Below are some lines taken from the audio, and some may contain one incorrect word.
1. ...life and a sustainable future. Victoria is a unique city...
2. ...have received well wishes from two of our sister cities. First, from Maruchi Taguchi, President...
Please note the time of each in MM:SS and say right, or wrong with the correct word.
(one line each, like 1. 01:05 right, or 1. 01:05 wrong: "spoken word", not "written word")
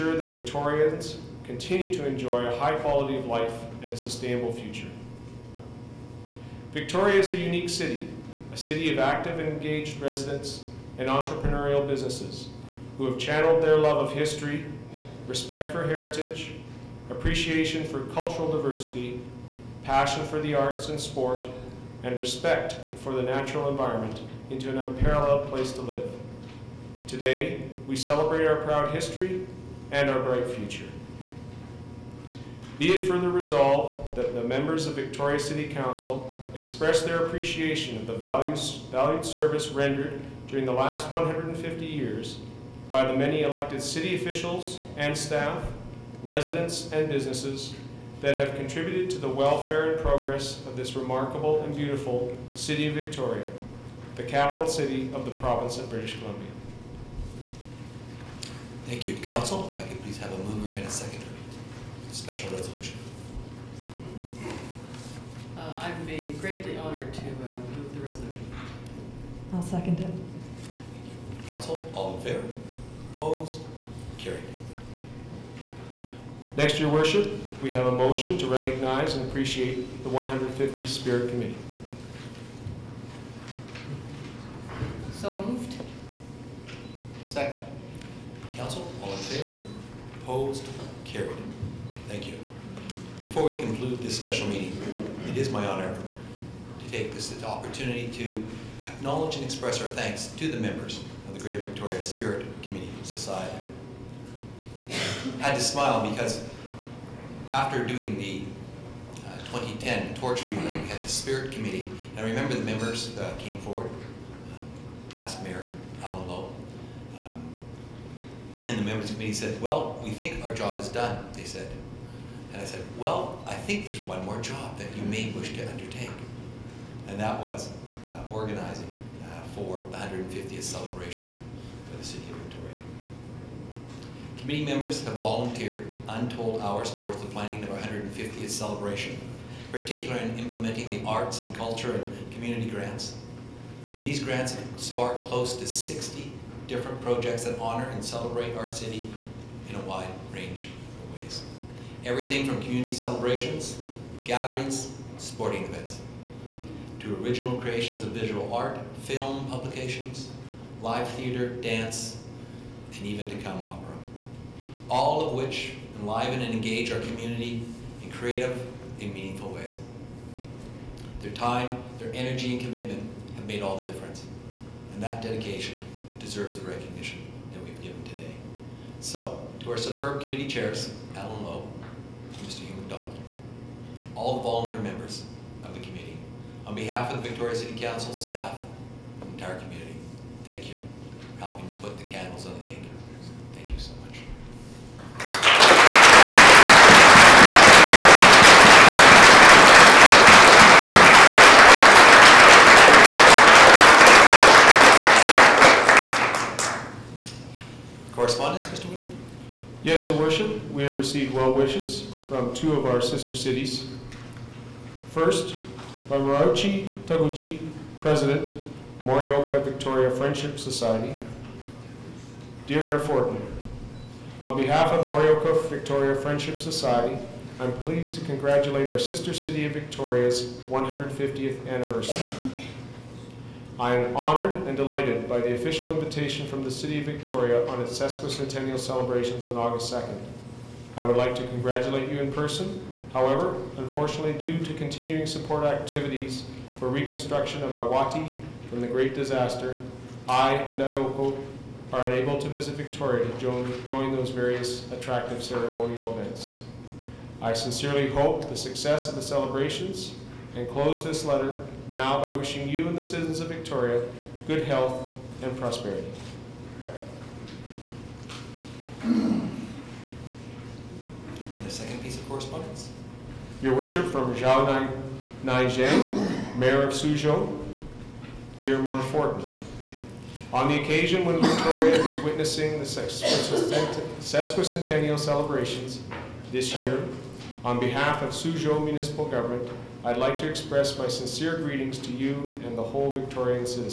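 1. 00:03 right
2. 03:30 right.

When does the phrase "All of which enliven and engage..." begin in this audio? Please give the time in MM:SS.
02:44.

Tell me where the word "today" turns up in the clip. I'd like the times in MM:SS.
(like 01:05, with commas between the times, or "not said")
00:27, 02:58.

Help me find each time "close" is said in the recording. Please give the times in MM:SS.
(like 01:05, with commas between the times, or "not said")
02:25, 04:20.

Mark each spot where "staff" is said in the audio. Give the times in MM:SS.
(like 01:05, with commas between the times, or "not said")
00:45, 03:08.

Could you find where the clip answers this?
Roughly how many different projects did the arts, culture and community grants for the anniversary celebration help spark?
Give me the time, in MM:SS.
02:25.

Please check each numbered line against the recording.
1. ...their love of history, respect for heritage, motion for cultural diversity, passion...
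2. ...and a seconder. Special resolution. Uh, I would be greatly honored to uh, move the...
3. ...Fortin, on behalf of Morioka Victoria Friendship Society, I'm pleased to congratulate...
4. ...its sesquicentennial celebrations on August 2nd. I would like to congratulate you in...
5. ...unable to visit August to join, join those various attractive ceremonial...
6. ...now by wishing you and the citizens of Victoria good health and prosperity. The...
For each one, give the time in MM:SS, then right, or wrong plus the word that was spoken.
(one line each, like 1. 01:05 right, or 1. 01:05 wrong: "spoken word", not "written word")
1. 00:13 wrong: "appreciation", not "motion"
2. 01:00 right
3. 03:42 right
4. 03:57 right
5. 04:12 wrong: "Victoria", not "August"
6. 04:21 right.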